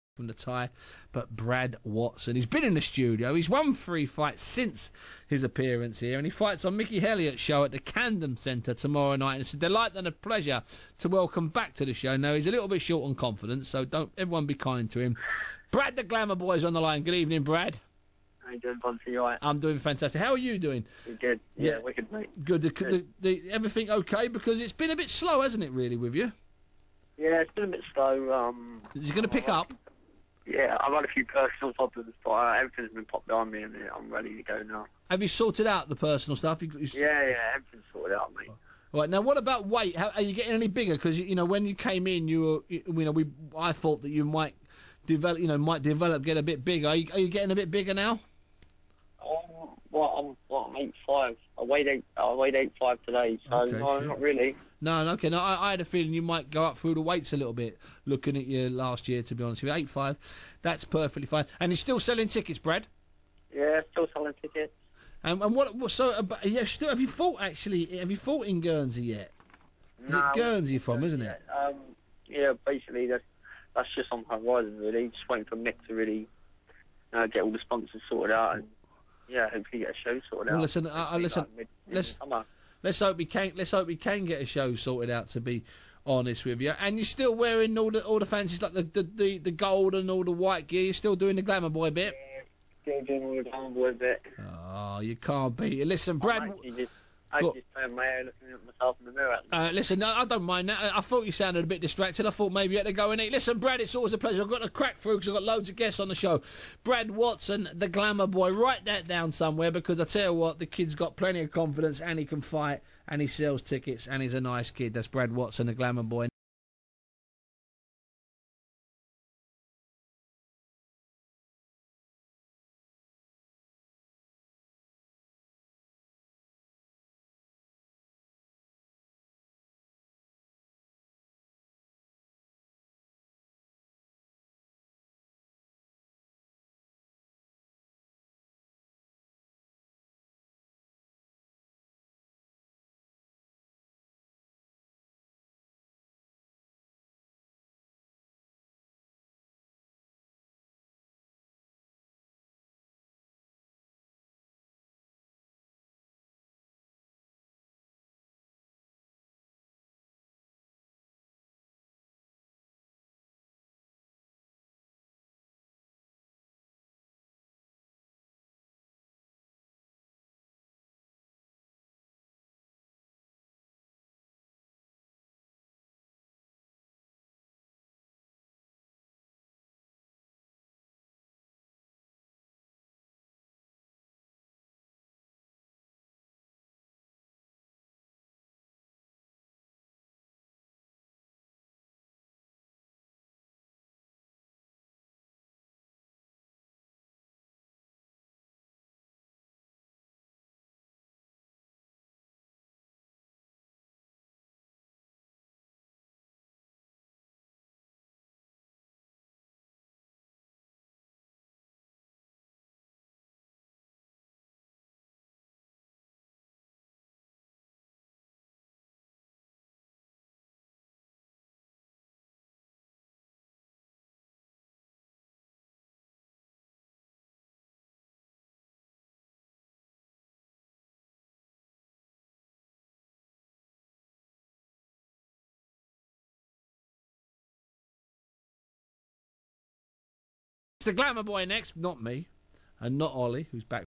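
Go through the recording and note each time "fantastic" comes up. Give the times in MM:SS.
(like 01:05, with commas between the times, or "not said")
00:19.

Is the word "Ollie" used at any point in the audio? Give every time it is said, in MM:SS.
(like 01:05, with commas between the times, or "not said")
04:03.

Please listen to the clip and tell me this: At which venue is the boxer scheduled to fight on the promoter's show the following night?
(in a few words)
Camden Centre.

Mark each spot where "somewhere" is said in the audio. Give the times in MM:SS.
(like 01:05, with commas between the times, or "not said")
01:49.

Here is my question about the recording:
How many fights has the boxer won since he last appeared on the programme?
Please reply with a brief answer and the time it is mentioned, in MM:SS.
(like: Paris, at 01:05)
3, at 00:03.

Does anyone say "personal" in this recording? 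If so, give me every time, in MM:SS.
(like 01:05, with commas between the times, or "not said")
00:31, 00:35.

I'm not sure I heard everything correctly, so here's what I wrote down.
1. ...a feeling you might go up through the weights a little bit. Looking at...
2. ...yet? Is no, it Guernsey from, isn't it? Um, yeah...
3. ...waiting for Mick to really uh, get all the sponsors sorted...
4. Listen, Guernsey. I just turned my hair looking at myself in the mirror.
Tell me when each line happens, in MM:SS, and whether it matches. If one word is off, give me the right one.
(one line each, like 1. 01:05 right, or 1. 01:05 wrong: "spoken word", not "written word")
1. 00:55 right
2. 01:09 right
3. 01:15 right
4. 01:35 wrong: "Brad", not "Guernsey".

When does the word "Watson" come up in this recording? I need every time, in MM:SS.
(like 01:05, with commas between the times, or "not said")
00:01, 01:47, 01:55.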